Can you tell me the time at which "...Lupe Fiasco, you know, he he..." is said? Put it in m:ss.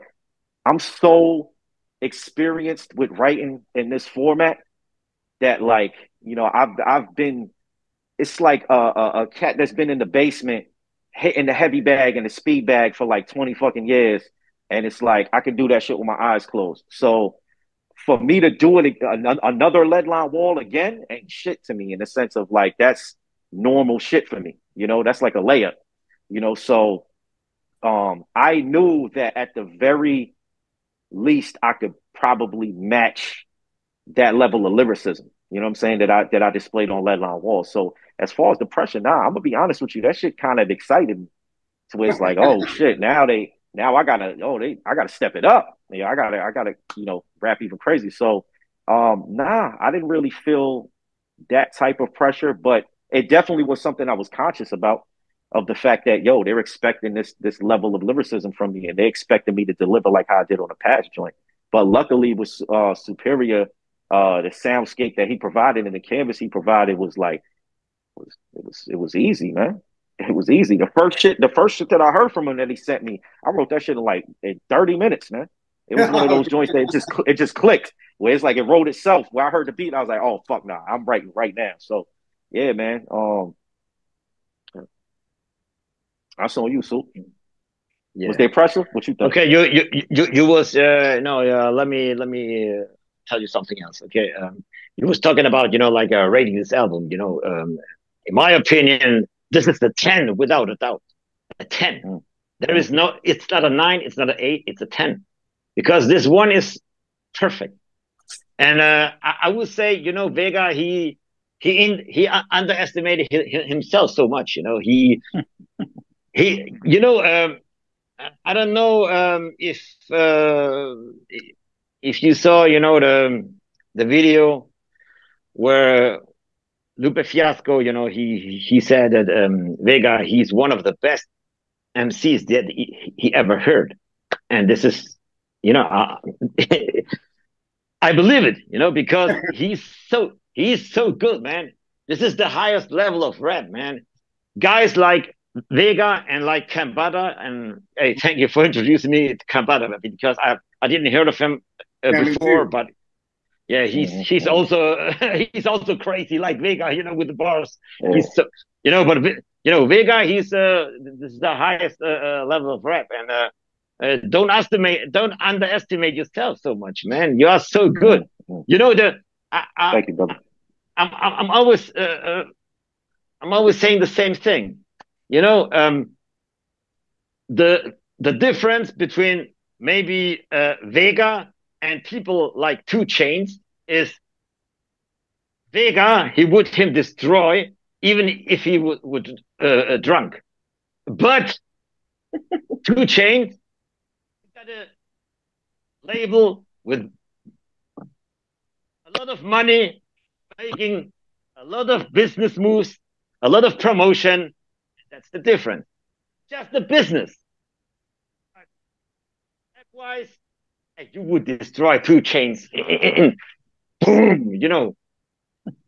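2:06.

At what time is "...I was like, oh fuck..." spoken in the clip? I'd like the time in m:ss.
1:19.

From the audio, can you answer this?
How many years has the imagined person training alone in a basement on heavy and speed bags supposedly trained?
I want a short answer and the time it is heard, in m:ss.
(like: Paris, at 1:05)
20, at 0:13.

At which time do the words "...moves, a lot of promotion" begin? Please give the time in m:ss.
3:22.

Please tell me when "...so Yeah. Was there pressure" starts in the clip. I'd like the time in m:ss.
1:26.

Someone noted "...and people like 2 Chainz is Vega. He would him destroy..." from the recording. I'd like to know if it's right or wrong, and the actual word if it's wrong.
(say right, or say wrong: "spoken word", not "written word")
right.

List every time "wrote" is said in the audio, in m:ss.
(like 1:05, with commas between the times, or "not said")
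1:13, 1:18.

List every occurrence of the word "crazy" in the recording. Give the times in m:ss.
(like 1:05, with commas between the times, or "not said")
0:47, 2:35.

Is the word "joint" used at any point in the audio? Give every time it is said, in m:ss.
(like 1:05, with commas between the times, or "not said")
1:01, 1:16.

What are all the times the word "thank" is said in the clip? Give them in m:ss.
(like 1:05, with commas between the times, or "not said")
2:28, 2:49.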